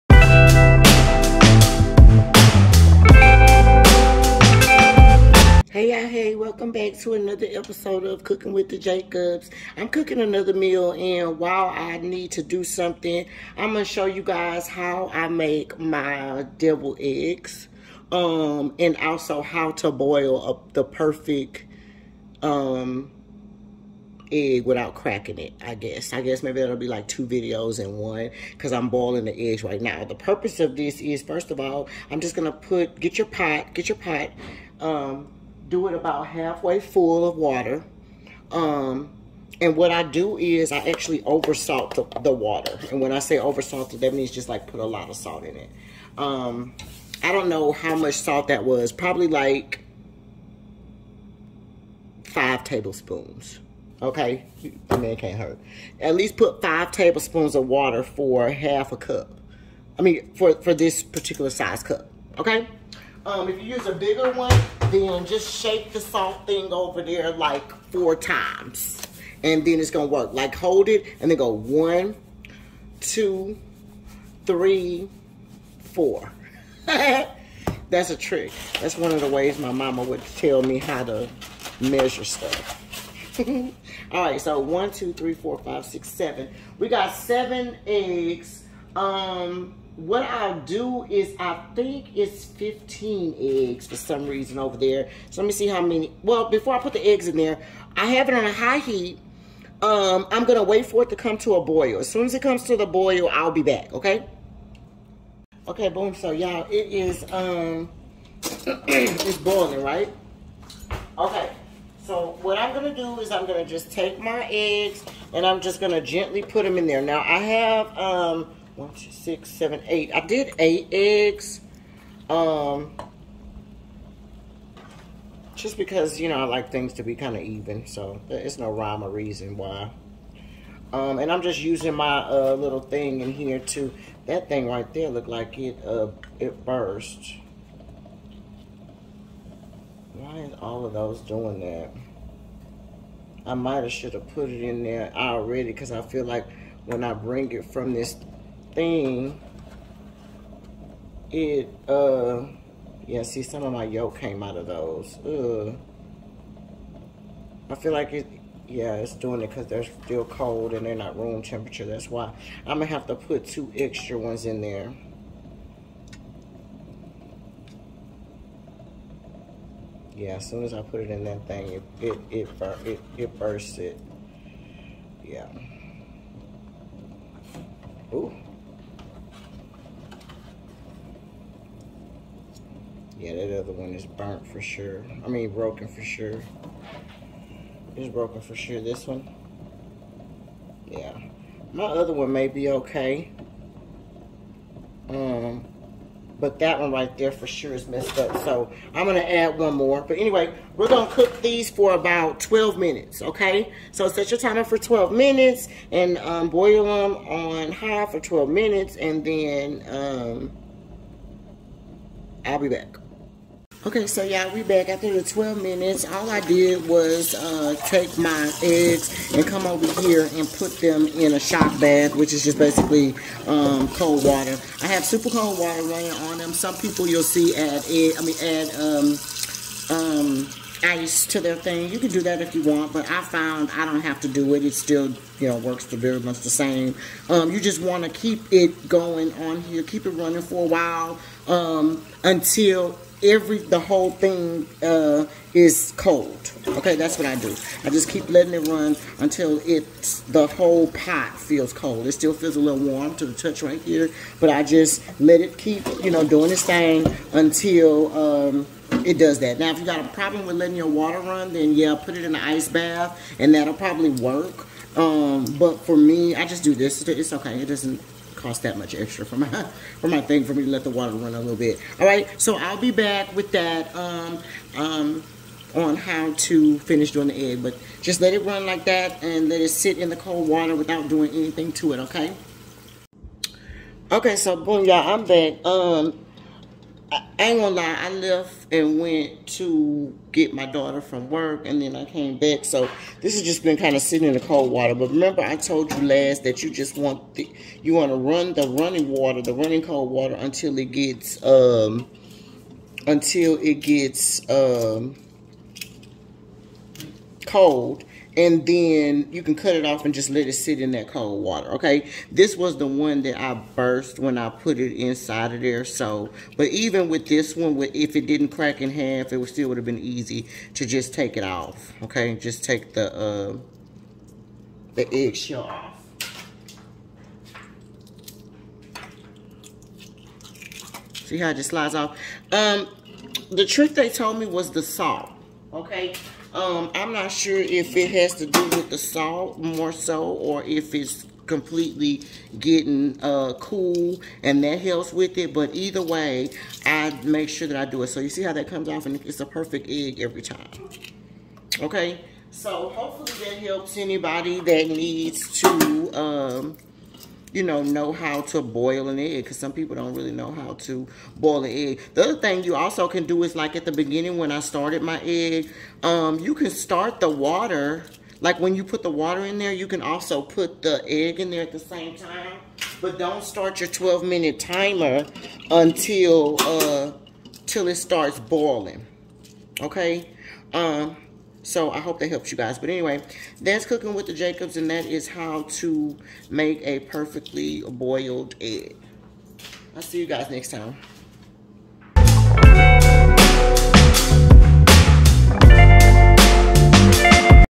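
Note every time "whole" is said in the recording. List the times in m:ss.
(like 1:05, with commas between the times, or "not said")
4:03, 4:10.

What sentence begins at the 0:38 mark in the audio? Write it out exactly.
Um, and what I do is I actually oversalt the, the water.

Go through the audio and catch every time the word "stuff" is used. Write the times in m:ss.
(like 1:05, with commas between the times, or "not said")
1:22.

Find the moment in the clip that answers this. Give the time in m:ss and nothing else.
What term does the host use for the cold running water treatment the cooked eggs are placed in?
3:41.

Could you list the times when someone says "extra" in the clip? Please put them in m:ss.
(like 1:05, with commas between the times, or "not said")
2:43, 4:28.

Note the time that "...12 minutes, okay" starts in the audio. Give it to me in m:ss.
3:22.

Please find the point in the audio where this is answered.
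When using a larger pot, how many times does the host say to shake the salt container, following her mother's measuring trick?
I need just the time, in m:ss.
1:07.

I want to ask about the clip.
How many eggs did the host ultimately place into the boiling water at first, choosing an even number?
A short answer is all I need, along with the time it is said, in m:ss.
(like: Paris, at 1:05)
8, at 2:00.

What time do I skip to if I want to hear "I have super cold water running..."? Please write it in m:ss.
3:44.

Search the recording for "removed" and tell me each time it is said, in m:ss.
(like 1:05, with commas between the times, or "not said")
not said.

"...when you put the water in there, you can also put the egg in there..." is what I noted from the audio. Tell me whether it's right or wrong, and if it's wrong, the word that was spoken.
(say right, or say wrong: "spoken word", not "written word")
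right.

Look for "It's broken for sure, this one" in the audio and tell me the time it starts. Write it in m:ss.
3:07.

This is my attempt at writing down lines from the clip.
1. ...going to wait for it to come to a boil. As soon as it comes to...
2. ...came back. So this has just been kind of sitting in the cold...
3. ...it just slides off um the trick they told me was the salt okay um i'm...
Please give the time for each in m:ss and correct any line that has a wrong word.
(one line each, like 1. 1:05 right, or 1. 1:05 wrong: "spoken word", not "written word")
1. 1:40 right
2. 4:52 right
3. 5:31 right.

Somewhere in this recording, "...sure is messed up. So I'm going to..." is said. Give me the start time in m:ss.
3:17.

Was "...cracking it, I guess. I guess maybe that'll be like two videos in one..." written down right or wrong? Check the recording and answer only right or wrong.
right.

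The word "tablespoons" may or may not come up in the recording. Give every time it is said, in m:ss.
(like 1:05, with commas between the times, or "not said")
0:52, 0:56.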